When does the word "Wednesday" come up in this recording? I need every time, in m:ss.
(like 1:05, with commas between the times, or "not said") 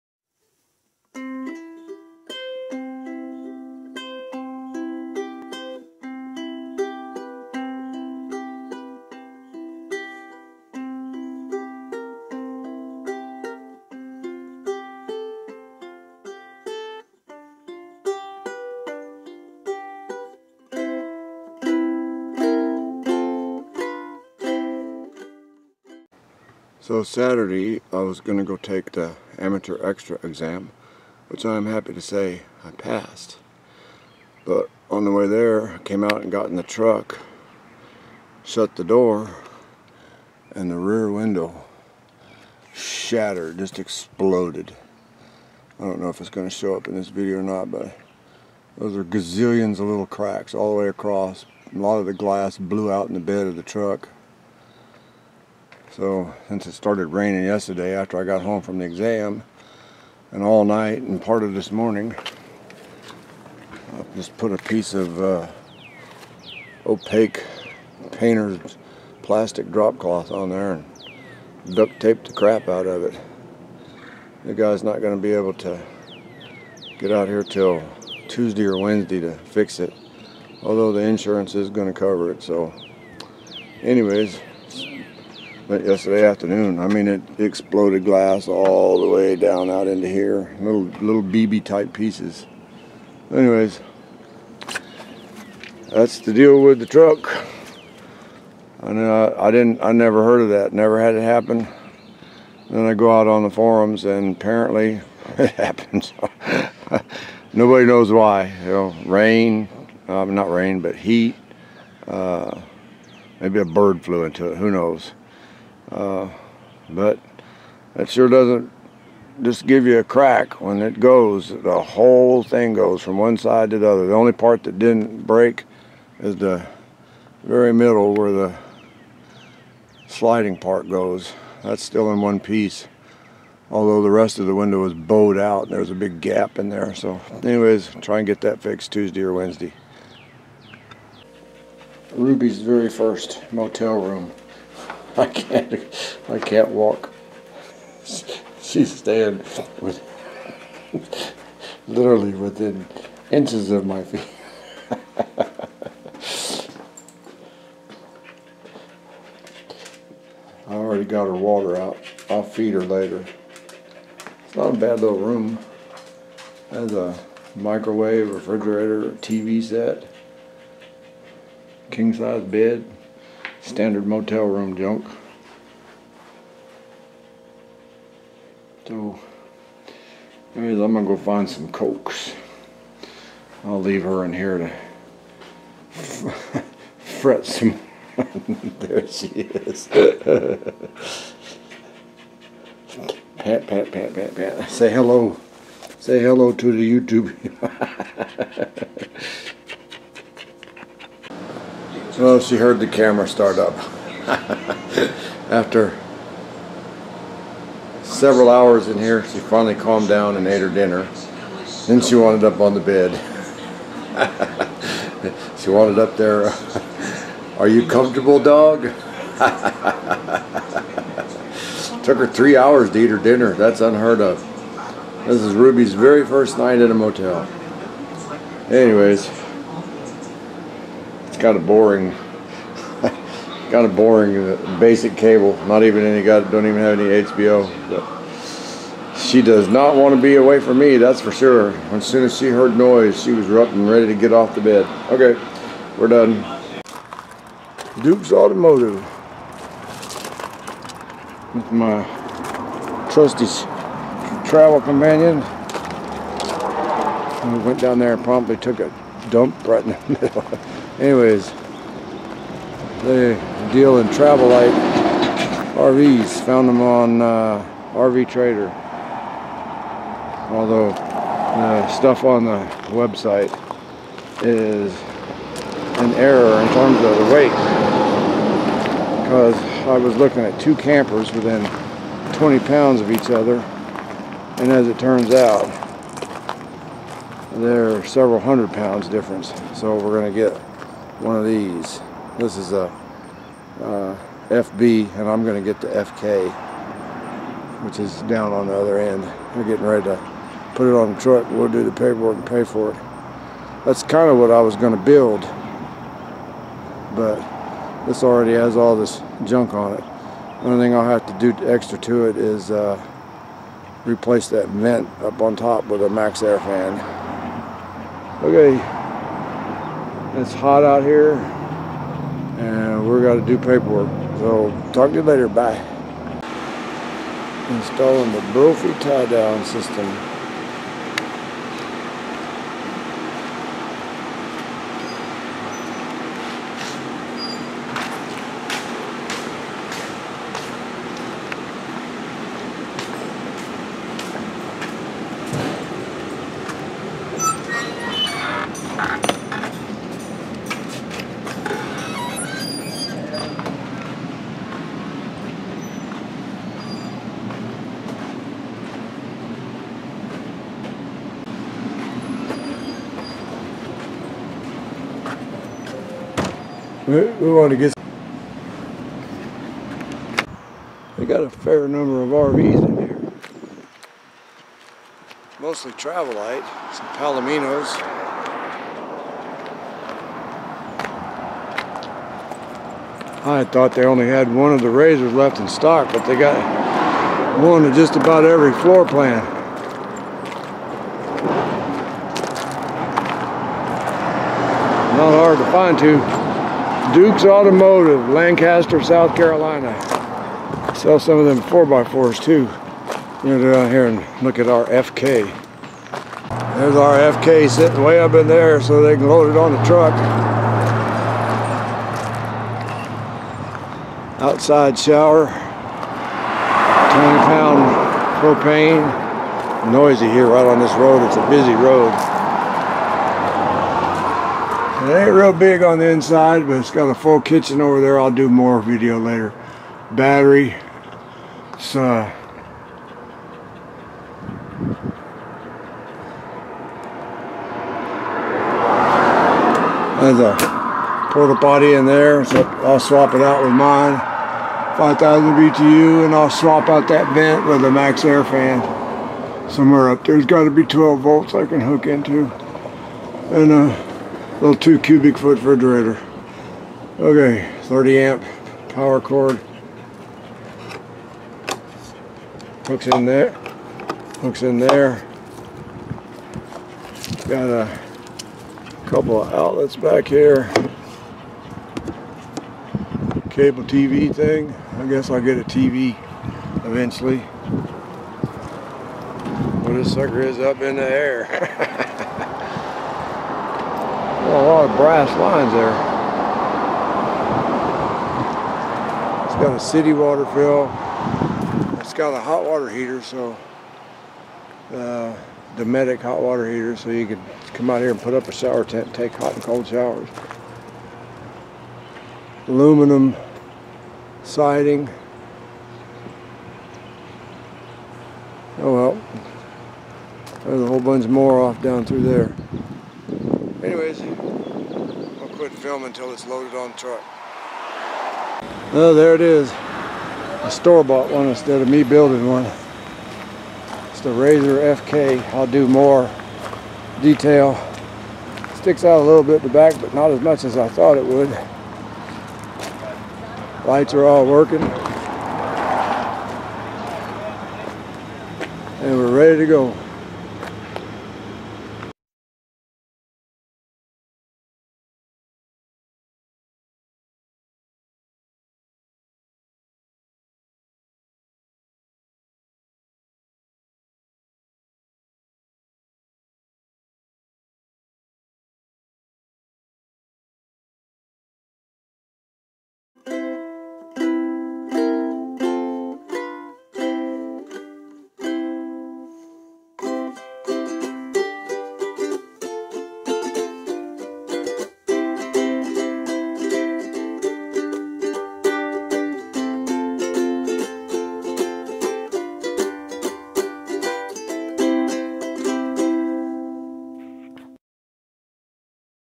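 1:18, 2:19.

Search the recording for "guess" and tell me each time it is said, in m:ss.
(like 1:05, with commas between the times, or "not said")
7:55.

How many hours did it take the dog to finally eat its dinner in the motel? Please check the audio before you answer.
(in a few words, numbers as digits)
3.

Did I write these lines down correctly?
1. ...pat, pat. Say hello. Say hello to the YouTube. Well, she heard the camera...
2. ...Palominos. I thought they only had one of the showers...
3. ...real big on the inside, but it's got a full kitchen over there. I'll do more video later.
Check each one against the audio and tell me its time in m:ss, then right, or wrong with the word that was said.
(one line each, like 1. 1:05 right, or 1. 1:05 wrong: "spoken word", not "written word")
1. 3:14 right
2. 6:17 wrong: "razors", not "showers"
3. 7:05 right.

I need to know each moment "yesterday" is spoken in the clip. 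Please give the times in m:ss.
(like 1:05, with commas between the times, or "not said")
0:57, 1:25.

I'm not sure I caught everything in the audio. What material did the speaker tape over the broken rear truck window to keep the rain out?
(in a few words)
Painter's plastic drop cloth.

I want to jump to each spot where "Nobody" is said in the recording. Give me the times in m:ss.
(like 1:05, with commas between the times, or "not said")
1:47.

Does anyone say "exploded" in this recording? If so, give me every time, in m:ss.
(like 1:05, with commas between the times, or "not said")
0:43, 1:27.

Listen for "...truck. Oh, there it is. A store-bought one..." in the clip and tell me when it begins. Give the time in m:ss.
8:36.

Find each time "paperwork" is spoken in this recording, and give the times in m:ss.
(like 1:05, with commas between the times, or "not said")
5:01, 5:23.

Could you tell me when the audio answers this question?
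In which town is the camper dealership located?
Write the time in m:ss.
6:38.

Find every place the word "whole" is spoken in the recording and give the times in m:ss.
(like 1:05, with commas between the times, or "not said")
2:01, 8:30.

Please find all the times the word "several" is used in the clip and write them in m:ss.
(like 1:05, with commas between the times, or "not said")
3:28, 4:48.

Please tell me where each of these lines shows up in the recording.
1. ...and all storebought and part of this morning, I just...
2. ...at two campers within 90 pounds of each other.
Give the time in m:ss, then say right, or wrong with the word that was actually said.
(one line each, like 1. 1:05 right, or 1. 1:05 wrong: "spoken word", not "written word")
1. 1:00 wrong: "night", not "storebought"
2. 4:40 wrong: "20", not "90".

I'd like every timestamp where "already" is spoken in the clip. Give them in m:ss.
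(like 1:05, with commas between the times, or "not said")
2:40, 5:08.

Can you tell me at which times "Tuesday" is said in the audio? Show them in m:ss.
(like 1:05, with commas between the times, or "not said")
1:18, 2:18.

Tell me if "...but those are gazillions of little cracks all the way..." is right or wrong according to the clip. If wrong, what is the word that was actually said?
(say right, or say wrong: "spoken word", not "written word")
right.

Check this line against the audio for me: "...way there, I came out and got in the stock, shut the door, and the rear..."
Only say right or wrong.
wrong.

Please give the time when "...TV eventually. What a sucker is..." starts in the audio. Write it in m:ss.
7:55.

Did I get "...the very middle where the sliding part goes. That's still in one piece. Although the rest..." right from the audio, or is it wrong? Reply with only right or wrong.
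right.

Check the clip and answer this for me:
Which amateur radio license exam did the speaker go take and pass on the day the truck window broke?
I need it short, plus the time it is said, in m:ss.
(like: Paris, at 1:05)
Amateur Extra, at 0:29.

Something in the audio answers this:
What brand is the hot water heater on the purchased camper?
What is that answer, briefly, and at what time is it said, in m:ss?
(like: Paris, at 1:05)
Dometic, at 8:15.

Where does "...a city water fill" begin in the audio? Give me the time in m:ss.
8:09.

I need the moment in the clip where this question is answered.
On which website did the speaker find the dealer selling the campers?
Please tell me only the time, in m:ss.
4:27.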